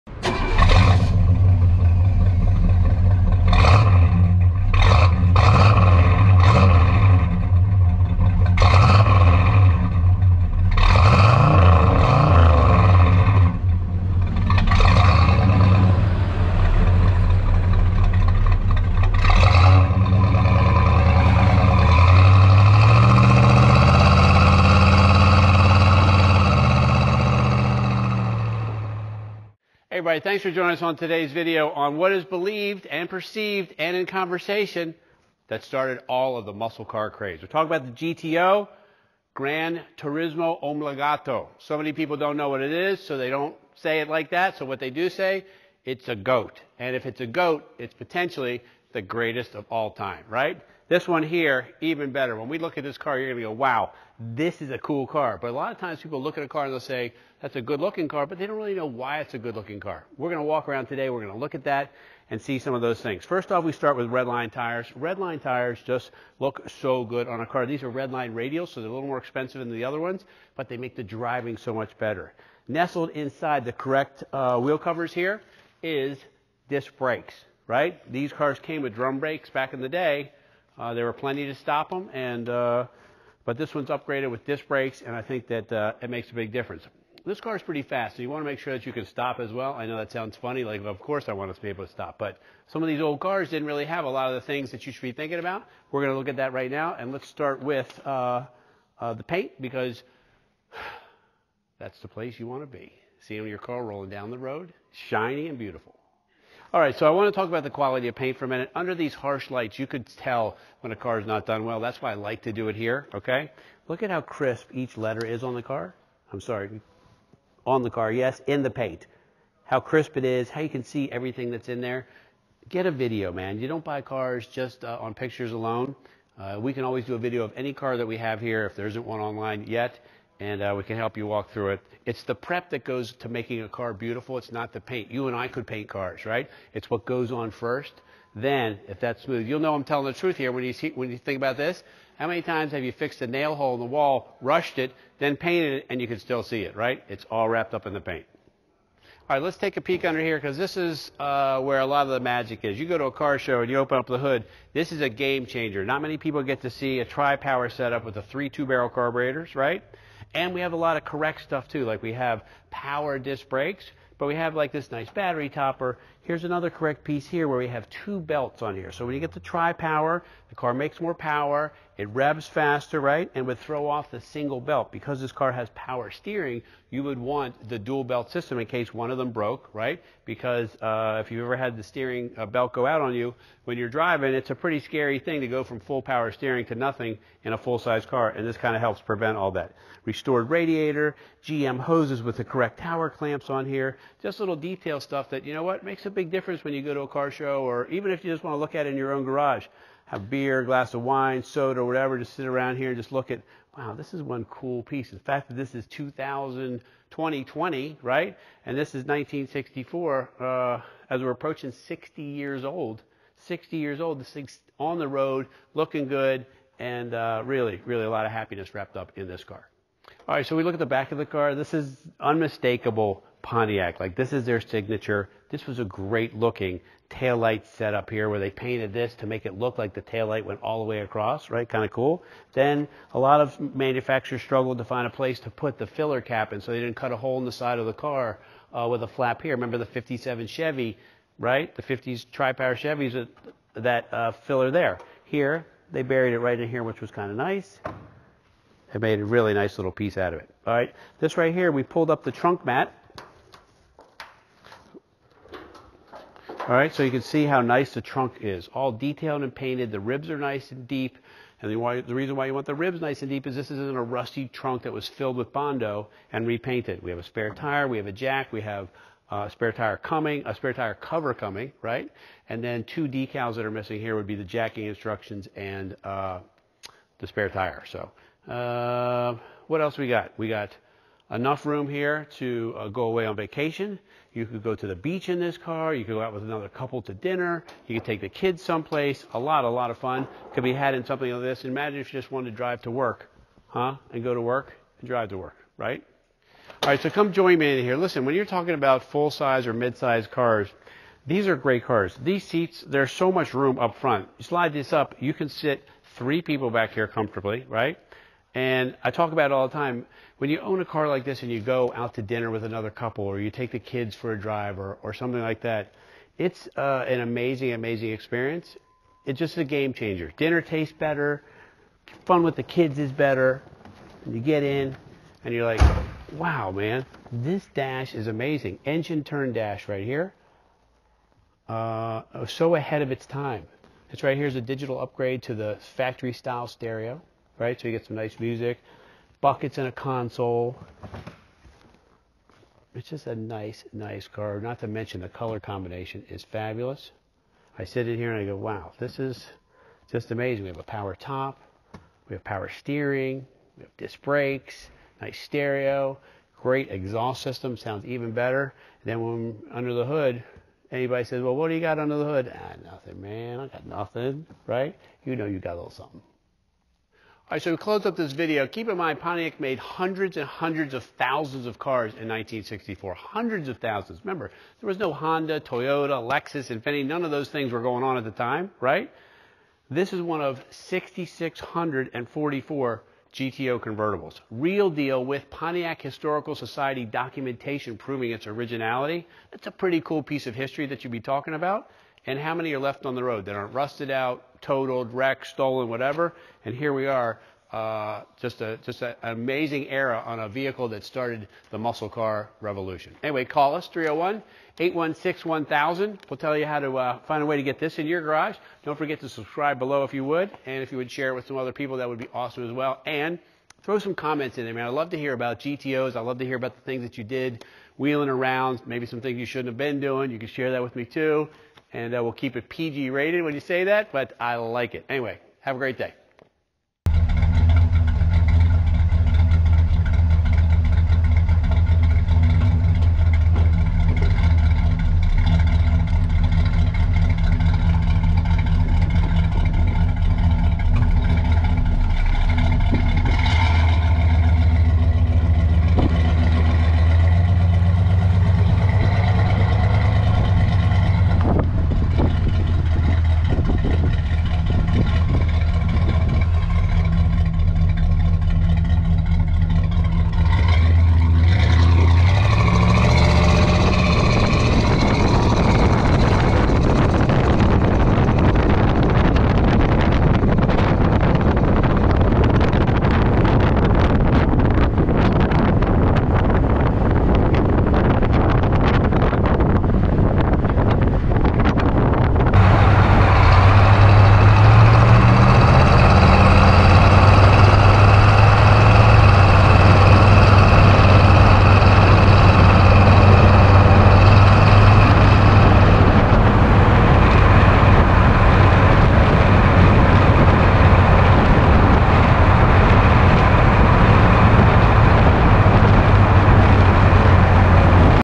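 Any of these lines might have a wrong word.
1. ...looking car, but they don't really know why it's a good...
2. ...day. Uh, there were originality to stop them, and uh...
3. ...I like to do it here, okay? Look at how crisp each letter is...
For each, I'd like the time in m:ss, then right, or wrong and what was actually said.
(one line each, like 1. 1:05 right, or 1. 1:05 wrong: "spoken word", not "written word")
1. 0:57 right
2. 1:19 wrong: "plenty", not "originality"
3. 1:52 right.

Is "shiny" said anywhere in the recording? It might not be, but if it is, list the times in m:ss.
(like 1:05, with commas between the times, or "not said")
1:44.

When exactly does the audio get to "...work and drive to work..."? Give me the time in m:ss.
4:54.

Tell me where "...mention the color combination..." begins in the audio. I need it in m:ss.
5:44.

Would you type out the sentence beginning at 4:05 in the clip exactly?
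Here, they buried it right in here, which was kind of nice.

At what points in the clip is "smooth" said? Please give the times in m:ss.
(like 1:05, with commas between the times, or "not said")
2:19.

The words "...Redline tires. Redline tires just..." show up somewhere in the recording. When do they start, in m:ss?
1:04.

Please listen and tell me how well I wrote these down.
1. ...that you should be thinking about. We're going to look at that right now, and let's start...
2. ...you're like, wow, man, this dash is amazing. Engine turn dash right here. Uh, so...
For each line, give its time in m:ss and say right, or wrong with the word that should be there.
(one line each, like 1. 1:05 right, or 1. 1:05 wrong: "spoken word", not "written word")
1. 1:34 right
2. 5:25 right.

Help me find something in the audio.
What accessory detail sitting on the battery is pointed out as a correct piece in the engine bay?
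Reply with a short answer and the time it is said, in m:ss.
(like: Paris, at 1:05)
Battery topper, at 2:45.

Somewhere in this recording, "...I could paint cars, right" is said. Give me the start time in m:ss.
2:15.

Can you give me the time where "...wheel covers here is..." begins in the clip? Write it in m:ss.
1:14.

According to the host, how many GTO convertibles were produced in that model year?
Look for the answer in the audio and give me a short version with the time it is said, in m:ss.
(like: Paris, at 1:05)
6,644, at 6:20.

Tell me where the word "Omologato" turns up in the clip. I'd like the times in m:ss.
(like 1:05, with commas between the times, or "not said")
0:40.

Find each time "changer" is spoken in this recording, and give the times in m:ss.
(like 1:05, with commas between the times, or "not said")
2:35, 5:19.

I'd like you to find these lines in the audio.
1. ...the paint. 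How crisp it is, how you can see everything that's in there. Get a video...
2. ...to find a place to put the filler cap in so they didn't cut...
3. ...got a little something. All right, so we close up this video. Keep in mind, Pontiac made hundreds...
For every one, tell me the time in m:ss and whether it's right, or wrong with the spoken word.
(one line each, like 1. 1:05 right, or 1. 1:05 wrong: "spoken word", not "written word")
1. 1:58 right
2. 3:54 right
3. 6:05 right.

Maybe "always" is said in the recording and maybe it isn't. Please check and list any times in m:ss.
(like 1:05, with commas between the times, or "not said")
2:06.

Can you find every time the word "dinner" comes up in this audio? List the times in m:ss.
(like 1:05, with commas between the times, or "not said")
4:47, 5:12, 5:20.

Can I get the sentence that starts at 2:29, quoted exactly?
All right, let's take a peek under here because this is uh, where a lot of the magic is.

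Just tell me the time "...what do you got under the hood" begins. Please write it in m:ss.
6:01.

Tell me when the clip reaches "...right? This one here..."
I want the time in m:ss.
0:50.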